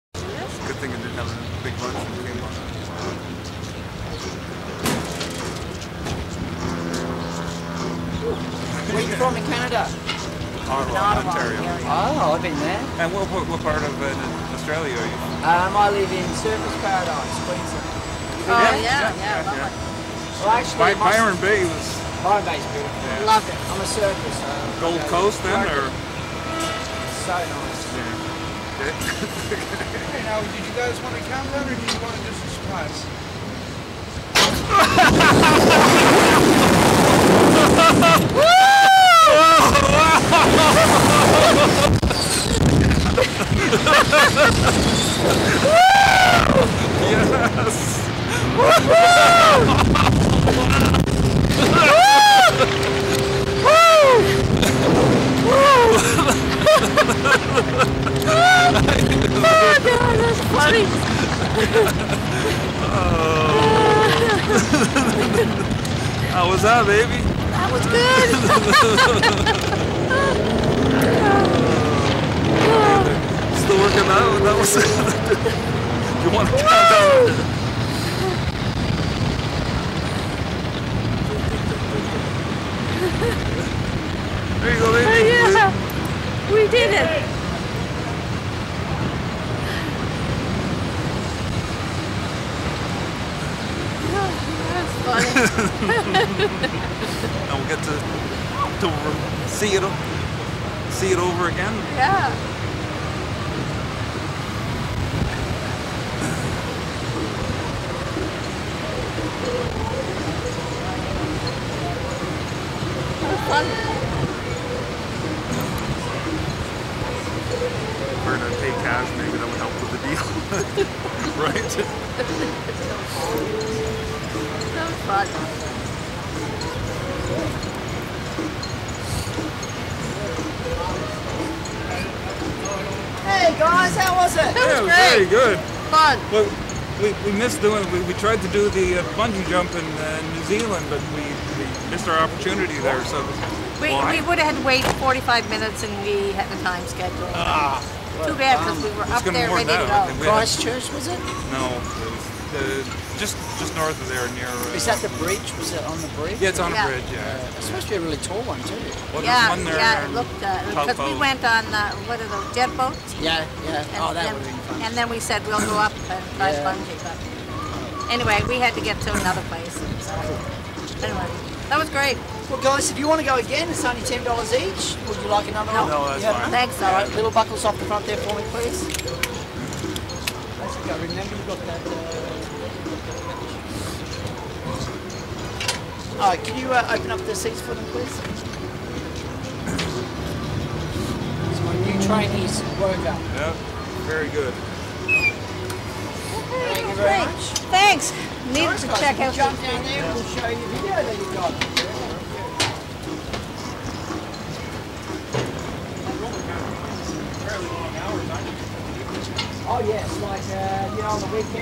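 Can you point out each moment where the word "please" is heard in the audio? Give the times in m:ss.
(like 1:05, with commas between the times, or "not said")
1:00, 2:58, 3:07.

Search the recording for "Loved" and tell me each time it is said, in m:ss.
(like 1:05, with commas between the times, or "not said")
0:23.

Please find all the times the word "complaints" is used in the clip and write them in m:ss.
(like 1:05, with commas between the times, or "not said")
not said.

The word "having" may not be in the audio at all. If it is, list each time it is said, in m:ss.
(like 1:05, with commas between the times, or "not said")
0:01.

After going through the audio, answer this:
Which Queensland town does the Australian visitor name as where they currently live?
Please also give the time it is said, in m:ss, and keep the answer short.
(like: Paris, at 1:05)
Surfers Paradise, at 0:16.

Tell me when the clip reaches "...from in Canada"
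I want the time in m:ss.
0:09.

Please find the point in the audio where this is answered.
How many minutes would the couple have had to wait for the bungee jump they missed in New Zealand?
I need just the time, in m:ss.
2:25.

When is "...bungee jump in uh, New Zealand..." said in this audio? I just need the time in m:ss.
2:19.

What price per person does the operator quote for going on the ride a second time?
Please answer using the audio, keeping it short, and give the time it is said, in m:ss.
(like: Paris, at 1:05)
$10, at 2:54.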